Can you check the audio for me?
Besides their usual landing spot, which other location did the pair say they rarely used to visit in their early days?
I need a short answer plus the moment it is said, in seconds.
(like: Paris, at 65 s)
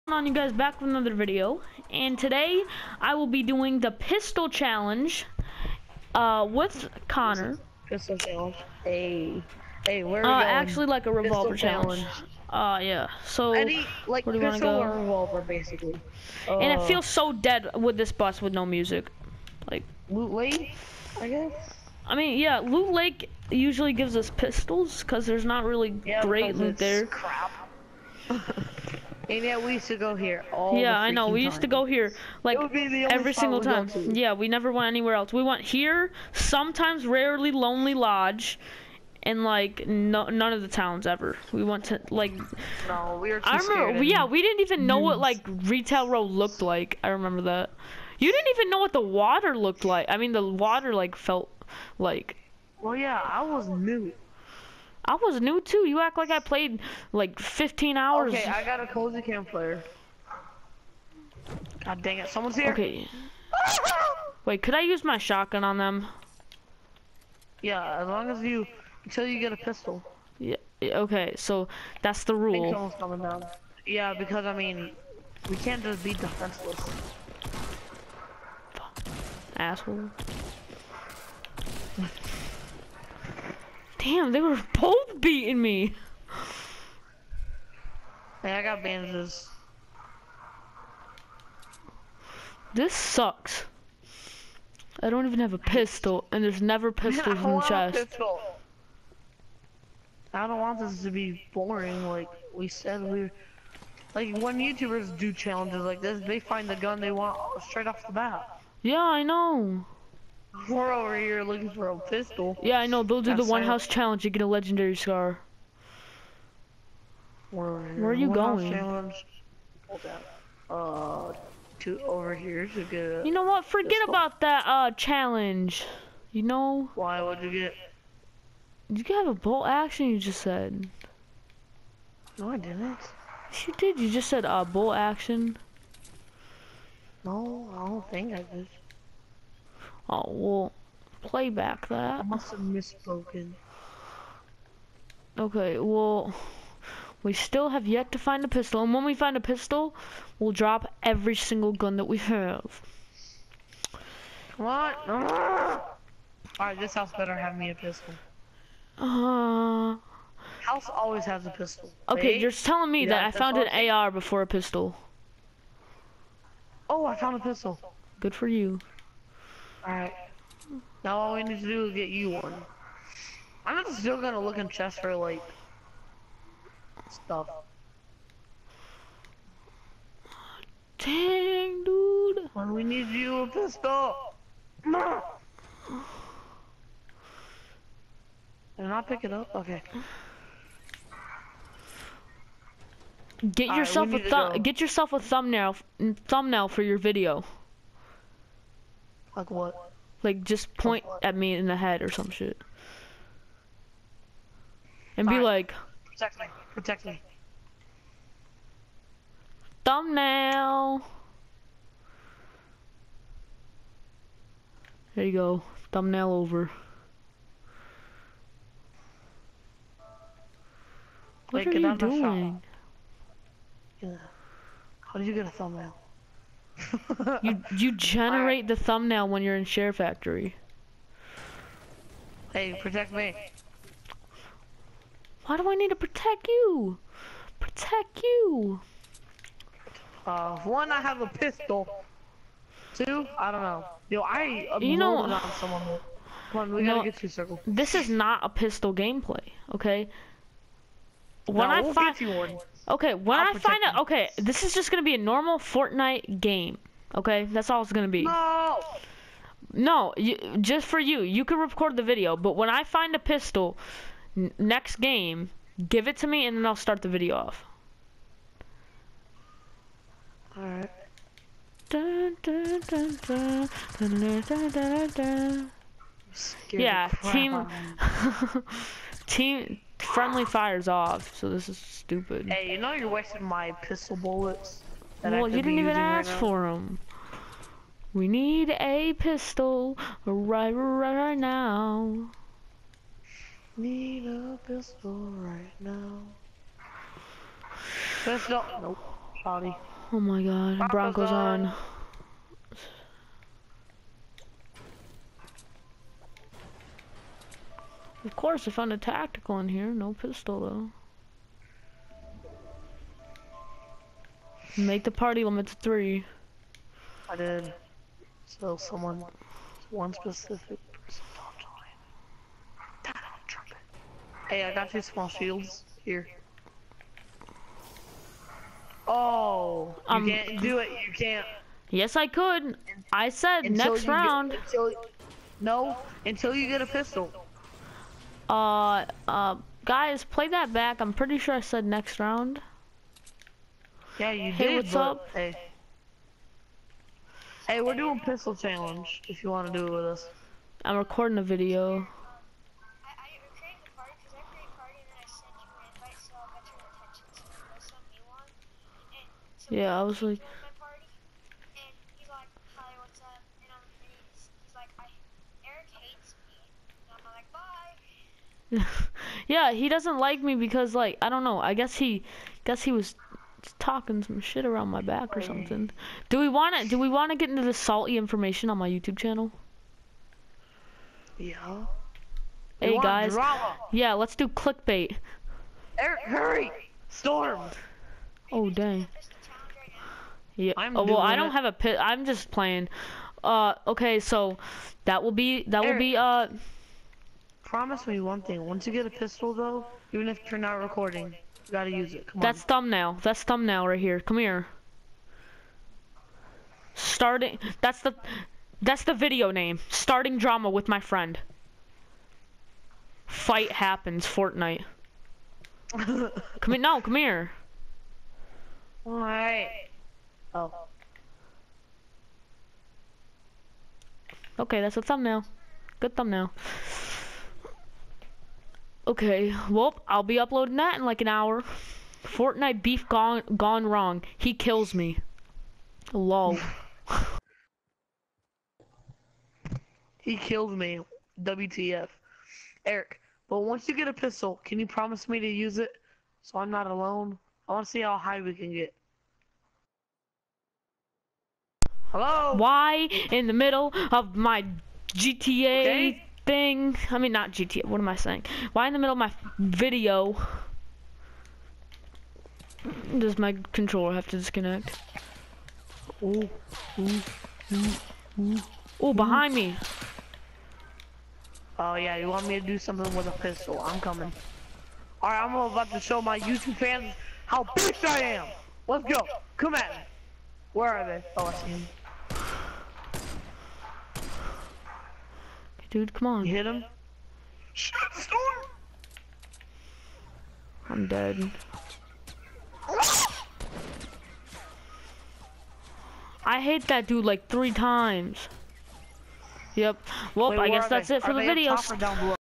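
Lonely Lodge, at 37 s.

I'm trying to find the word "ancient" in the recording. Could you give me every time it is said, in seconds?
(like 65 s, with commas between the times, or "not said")
not said.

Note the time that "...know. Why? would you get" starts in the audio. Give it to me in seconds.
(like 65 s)
126 s.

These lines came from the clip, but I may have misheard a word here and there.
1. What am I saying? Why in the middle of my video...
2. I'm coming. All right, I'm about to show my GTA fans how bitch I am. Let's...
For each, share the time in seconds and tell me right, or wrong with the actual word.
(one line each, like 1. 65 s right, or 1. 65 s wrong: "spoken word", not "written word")
1. 457 s right
2. 473 s wrong: "YouTube", not "GTA".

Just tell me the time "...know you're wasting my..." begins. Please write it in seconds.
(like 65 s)
282 s.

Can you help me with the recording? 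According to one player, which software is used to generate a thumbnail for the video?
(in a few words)
SHAREfactory.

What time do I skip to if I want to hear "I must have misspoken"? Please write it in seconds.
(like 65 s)
142 s.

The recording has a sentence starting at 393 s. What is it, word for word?
Uh, okay, so that will be that Eric.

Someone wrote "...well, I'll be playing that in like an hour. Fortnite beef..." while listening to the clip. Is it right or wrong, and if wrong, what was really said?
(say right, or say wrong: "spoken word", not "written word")
wrong: "uploading", not "playing".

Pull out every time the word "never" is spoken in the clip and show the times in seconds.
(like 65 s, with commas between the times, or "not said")
34 s, 96 s.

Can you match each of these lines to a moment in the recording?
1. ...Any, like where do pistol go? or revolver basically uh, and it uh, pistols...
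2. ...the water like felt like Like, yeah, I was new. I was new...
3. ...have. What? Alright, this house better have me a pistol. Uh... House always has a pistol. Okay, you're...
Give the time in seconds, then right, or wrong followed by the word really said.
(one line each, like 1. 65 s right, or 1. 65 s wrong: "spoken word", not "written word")
1. 13 s wrong: "feels", not "pistols"
2. 50 s wrong: "Well", not "Like"
3. 152 s right.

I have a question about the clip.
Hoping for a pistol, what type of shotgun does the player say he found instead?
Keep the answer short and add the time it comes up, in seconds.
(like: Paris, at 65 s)
tactical, at 308 s.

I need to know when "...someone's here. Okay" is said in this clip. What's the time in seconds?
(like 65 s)
62 s.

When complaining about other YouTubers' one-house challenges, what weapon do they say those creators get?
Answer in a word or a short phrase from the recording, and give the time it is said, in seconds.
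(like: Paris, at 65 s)
legendary scar, at 114 s.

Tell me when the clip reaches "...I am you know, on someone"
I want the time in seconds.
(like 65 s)
244 s.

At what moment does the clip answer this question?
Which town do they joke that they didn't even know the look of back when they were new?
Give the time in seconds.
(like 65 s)
45 s.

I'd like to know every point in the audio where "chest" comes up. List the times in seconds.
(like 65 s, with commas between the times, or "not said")
97 s, 174 s.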